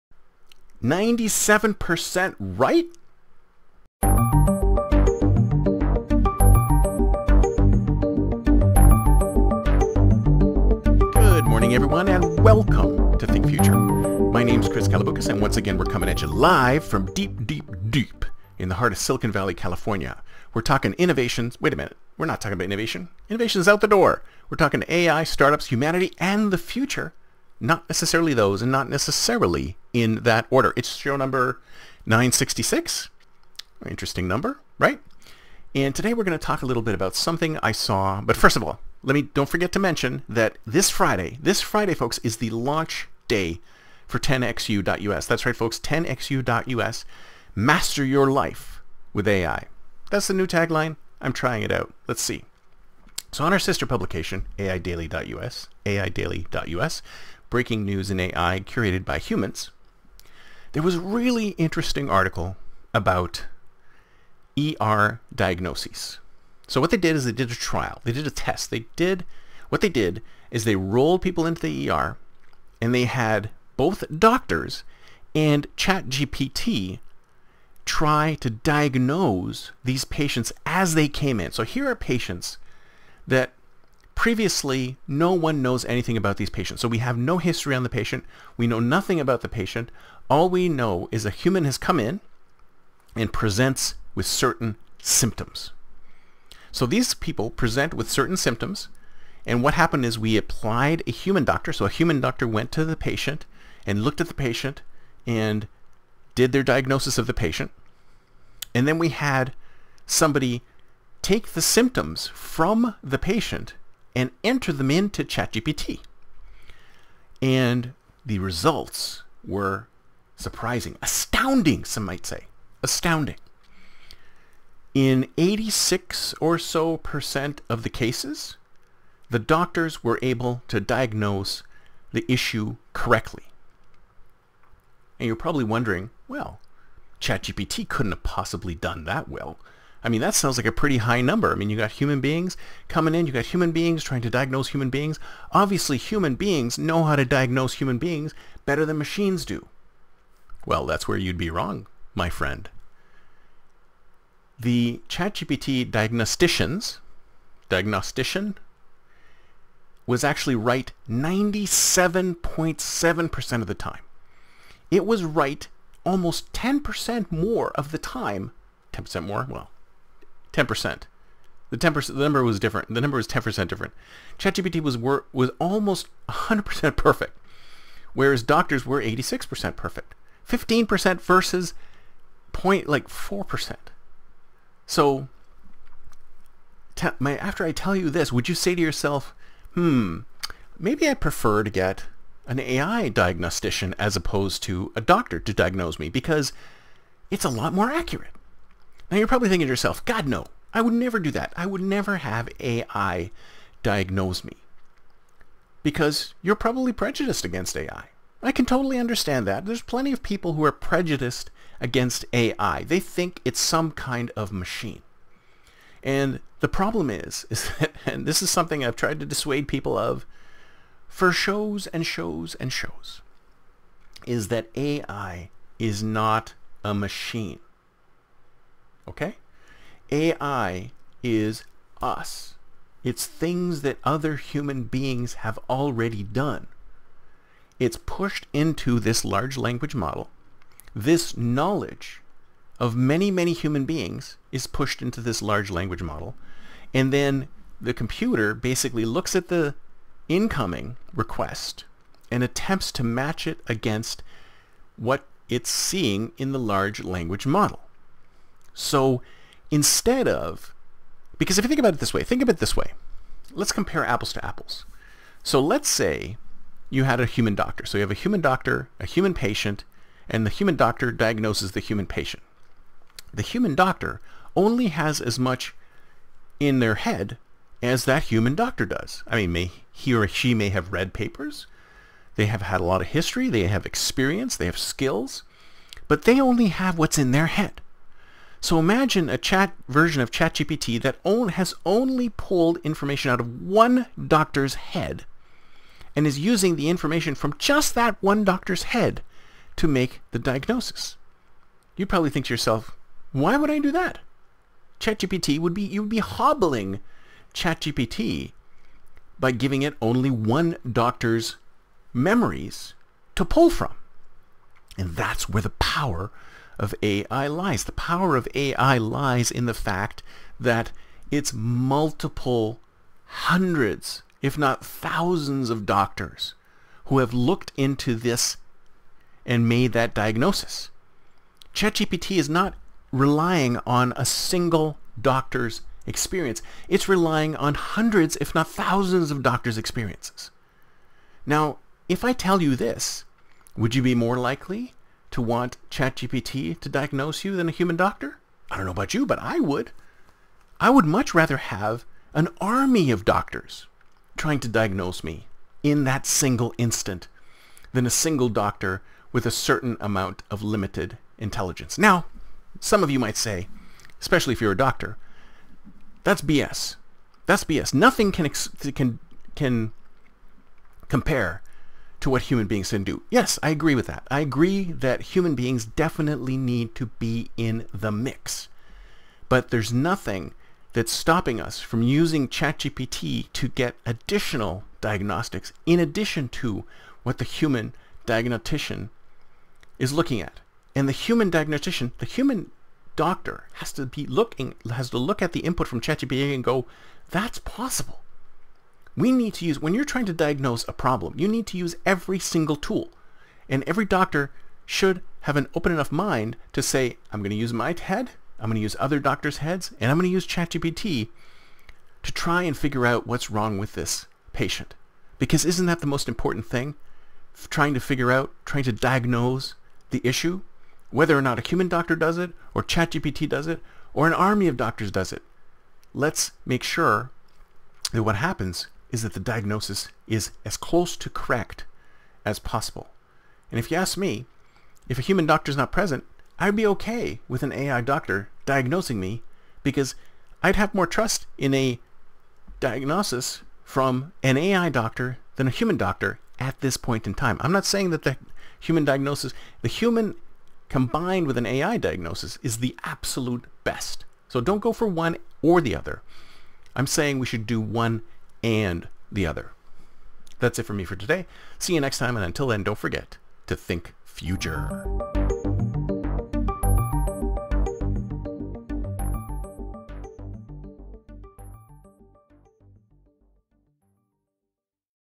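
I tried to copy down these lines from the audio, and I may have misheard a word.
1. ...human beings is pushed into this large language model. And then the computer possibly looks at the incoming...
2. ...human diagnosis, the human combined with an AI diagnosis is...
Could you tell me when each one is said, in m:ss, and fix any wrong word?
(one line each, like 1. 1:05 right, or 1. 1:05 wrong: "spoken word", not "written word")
1. 4:03 wrong: "basically", not "possibly"
2. 7:28 right.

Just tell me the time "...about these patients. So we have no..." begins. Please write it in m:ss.
1:26.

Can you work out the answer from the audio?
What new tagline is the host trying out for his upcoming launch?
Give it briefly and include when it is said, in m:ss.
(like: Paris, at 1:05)
Master your life with AI, at 0:47.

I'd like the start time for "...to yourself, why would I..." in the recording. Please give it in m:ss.
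5:02.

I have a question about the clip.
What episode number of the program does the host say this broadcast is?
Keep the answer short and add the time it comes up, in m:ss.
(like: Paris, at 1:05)
966, at 0:31.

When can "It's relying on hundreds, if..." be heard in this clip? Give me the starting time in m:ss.
5:36.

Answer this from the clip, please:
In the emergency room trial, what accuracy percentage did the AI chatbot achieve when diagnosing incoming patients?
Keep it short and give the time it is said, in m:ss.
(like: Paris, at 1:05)
97.7%, at 2:41.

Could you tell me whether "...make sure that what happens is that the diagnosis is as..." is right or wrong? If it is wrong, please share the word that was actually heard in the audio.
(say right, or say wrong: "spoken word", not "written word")
right.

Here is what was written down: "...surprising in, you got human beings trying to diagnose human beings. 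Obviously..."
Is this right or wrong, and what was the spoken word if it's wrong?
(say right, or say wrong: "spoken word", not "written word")
wrong: "coming", not "surprising".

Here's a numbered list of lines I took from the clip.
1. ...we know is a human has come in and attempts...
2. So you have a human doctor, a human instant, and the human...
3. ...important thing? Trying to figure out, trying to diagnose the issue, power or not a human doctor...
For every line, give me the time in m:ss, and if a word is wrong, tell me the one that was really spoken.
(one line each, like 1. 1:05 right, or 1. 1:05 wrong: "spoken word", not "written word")
1. 1:30 wrong: "presents", not "attempts"
2. 4:27 wrong: "patient", not "instant"
3. 6:56 wrong: "whether", not "power".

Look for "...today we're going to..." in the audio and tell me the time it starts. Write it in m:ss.
0:35.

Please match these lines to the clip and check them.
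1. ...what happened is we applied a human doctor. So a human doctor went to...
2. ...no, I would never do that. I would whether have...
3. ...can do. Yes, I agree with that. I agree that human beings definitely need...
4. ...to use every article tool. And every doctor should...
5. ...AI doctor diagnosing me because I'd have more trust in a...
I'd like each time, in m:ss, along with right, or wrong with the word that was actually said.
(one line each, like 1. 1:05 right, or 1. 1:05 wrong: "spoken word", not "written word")
1. 1:39 right
2. 3:20 wrong: "never", not "whether"
3. 6:12 right
4. 6:41 wrong: "single", not "article"
5. 7:17 right.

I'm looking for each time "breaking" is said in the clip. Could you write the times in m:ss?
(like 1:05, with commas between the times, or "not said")
0:57.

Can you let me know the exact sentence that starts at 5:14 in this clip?
And that's where the power of AI lies.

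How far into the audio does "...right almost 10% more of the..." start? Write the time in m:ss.
2:45.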